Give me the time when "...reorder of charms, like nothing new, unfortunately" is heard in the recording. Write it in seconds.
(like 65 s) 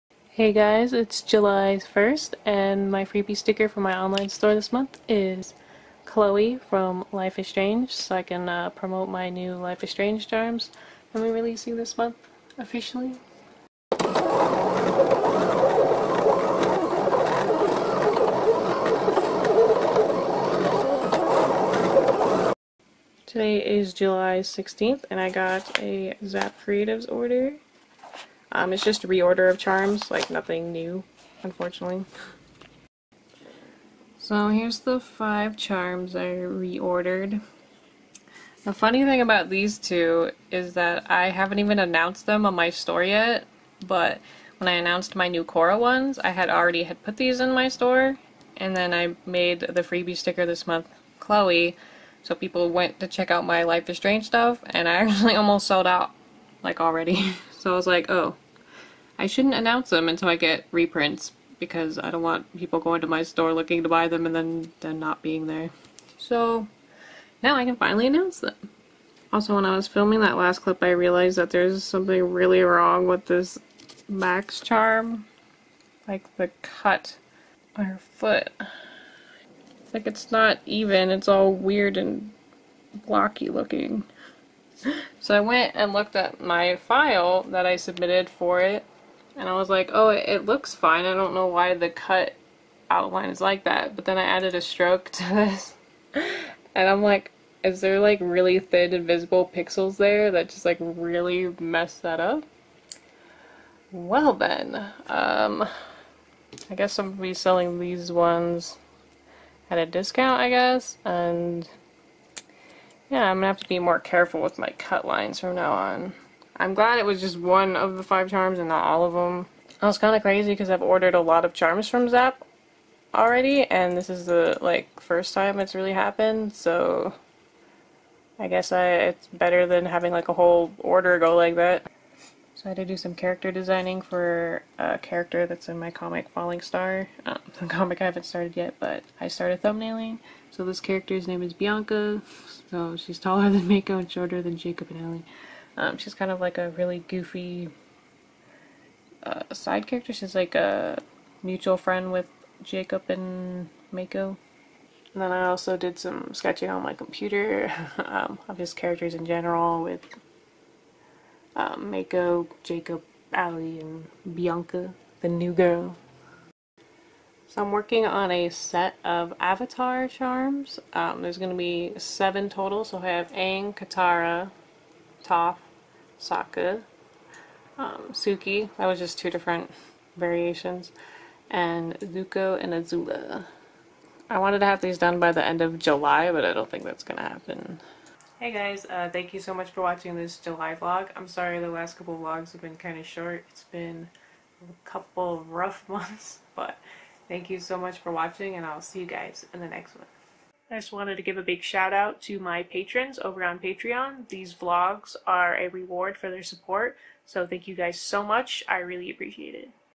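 29 s.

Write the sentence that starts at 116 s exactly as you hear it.
I'm glad it was just one of the five charms and not all of them.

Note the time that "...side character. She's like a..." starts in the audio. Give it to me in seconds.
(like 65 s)
149 s.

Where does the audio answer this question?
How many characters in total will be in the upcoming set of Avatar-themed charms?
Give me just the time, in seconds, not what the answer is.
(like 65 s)
171 s.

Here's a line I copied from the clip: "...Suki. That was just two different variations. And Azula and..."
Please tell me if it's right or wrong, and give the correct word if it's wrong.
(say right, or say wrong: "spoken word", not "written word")
wrong: "Zuko", not "Azula".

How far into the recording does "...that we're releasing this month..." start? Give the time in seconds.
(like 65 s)
11 s.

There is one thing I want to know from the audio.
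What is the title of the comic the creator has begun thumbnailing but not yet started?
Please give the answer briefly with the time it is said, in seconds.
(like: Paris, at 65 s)
Falling Star, at 136 s.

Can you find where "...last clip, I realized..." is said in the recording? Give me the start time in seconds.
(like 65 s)
70 s.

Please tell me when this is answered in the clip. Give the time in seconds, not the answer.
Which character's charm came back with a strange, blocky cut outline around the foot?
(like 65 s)
74 s.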